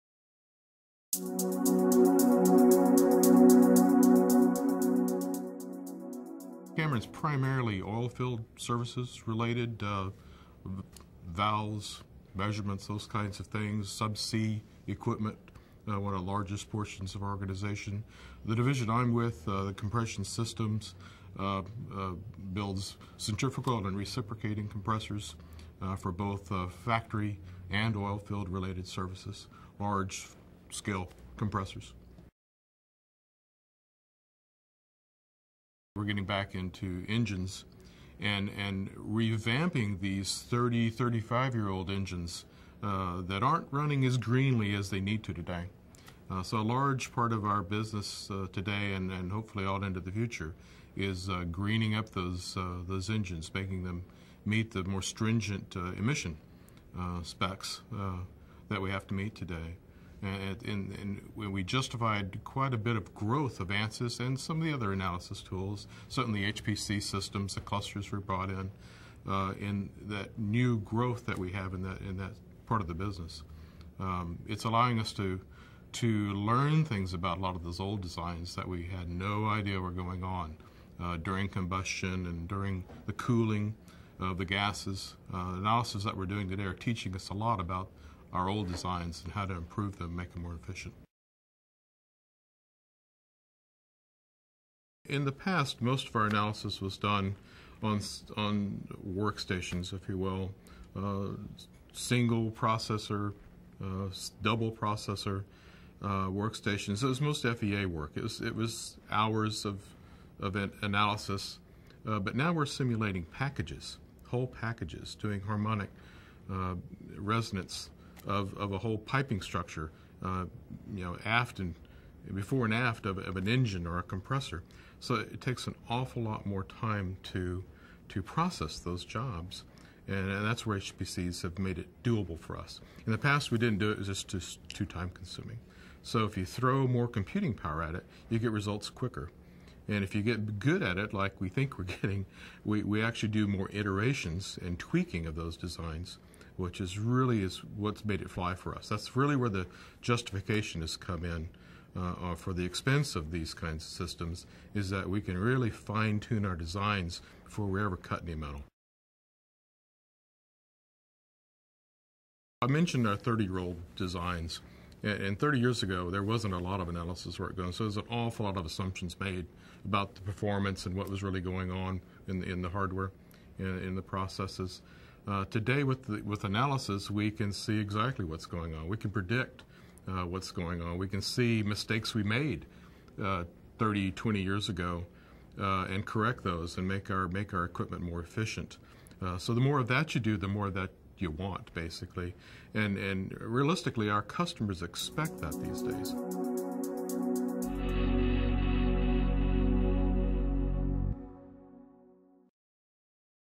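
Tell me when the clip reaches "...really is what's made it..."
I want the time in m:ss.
2:26.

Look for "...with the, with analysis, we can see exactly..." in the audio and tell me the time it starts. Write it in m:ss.
2:55.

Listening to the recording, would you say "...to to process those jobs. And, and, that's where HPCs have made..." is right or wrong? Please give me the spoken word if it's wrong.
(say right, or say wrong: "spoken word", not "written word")
right.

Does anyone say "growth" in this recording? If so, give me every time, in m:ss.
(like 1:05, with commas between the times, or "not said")
1:03, 1:10.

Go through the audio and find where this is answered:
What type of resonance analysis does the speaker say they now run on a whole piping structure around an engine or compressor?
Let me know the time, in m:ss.
1:55.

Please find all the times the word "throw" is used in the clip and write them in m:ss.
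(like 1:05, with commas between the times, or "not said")
2:16.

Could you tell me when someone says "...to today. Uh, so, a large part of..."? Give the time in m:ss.
0:45.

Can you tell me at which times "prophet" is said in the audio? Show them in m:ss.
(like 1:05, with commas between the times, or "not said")
not said.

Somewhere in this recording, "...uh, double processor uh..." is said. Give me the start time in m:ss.
1:43.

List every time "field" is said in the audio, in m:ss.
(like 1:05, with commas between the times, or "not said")
0:07, 0:28.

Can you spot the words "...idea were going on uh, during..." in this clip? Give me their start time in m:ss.
1:19.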